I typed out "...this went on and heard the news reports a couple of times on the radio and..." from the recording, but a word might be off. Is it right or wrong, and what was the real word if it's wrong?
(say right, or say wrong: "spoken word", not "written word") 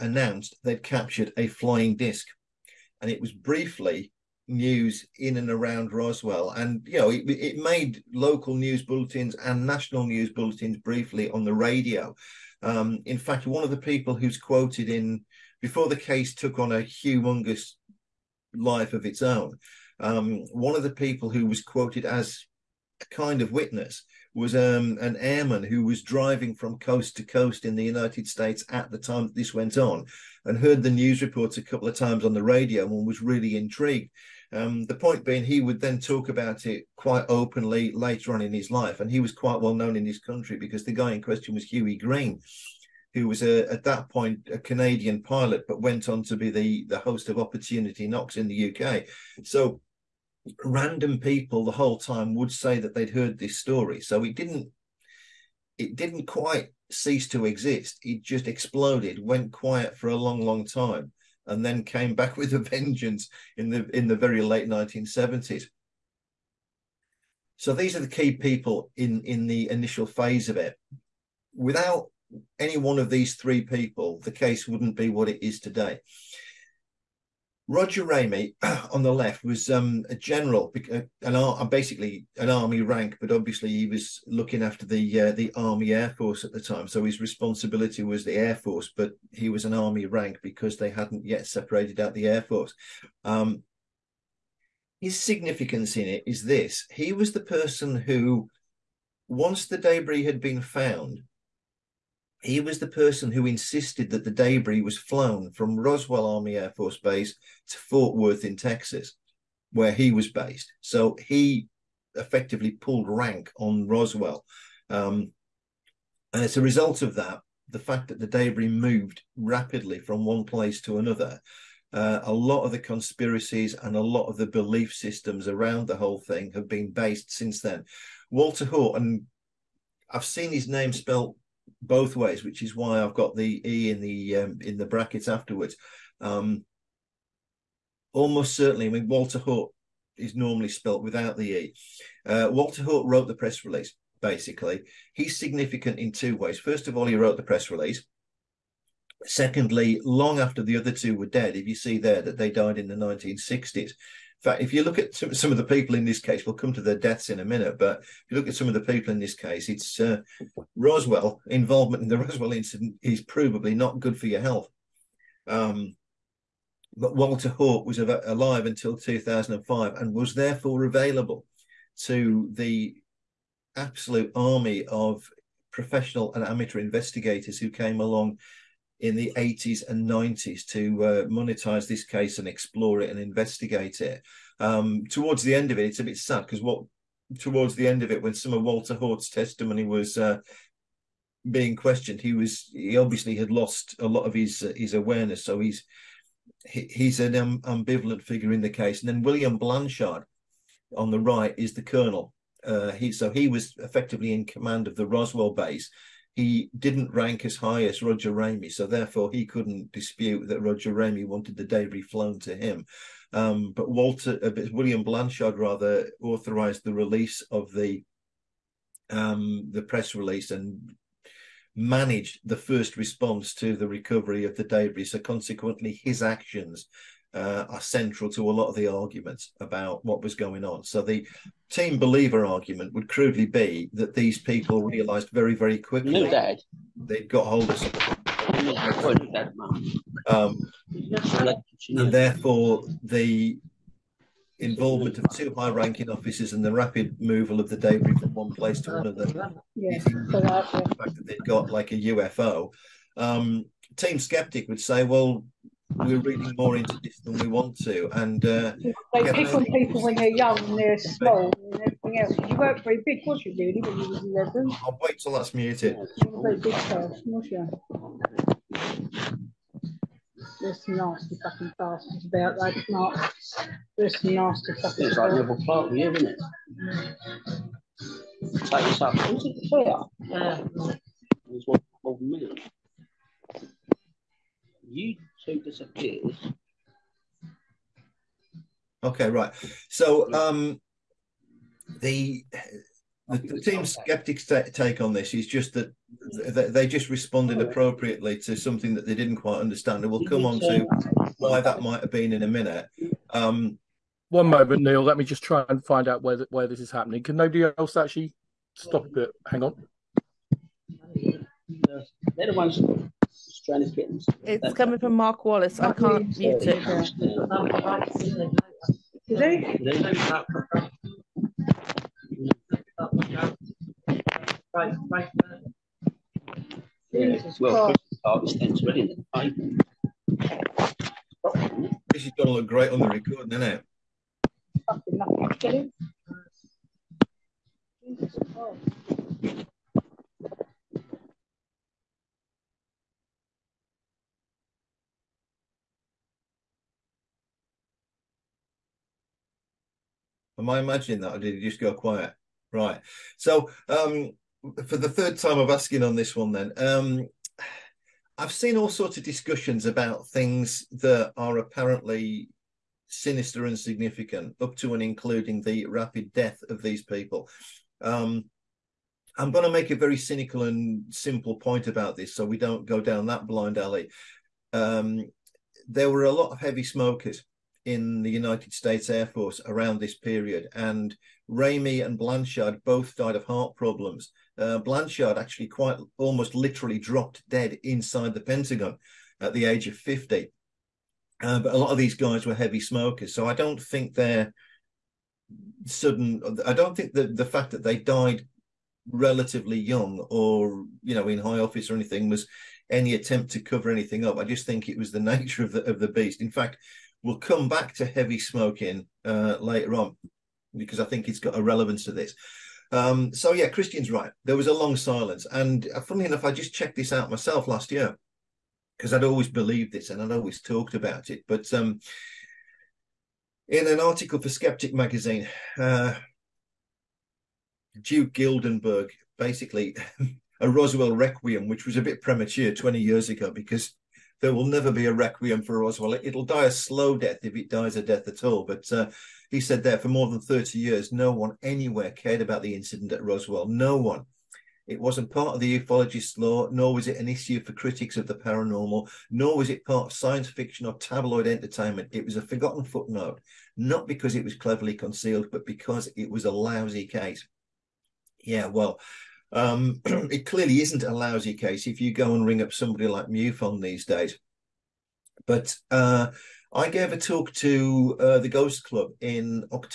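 right.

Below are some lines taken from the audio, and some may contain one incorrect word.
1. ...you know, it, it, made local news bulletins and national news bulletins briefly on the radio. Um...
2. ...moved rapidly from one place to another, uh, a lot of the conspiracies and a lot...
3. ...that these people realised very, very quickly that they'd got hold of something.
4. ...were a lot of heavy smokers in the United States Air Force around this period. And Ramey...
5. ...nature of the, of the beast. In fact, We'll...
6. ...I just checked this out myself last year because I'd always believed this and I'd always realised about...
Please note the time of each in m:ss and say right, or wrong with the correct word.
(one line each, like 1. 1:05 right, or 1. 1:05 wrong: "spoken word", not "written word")
1. 0:06 right
2. 1:58 right
3. 3:53 right
4. 6:16 right
5. 6:45 right
6. 6:56 wrong: "talked", not "realised".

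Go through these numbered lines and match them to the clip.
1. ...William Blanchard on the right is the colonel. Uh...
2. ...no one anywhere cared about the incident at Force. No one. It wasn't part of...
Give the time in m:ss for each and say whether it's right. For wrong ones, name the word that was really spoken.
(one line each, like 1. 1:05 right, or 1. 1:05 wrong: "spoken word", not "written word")
1. 3:19 right
2. 7:21 wrong: "Roswell", not "Force".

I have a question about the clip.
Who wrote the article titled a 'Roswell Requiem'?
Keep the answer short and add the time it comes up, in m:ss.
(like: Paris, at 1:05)
Duke Gildenberg, at 7:08.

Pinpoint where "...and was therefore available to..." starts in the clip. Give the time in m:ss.
2:49.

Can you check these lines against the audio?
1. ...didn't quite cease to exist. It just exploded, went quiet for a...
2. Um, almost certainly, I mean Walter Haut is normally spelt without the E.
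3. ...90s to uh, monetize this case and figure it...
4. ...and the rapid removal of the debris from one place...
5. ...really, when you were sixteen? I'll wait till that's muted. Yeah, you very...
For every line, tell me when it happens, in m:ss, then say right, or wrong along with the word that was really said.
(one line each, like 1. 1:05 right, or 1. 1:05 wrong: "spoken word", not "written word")
1. 0:55 right
2. 2:16 right
3. 3:00 wrong: "explore", not "figure"
4. 4:06 right
5. 4:23 wrong: "eleven", not "sixteen".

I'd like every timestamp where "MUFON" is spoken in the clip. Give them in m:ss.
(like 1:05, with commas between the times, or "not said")
7:43.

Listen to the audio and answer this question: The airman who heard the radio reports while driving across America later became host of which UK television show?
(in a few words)
Opportunity Knocks.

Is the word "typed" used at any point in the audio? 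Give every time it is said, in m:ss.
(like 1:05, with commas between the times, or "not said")
not said.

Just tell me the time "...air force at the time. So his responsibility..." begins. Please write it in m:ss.
1:25.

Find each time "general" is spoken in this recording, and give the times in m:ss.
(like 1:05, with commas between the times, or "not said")
1:20.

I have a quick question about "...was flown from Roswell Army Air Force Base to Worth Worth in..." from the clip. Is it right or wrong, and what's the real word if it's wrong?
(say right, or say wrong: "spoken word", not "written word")
wrong: "Fort", not "Worth".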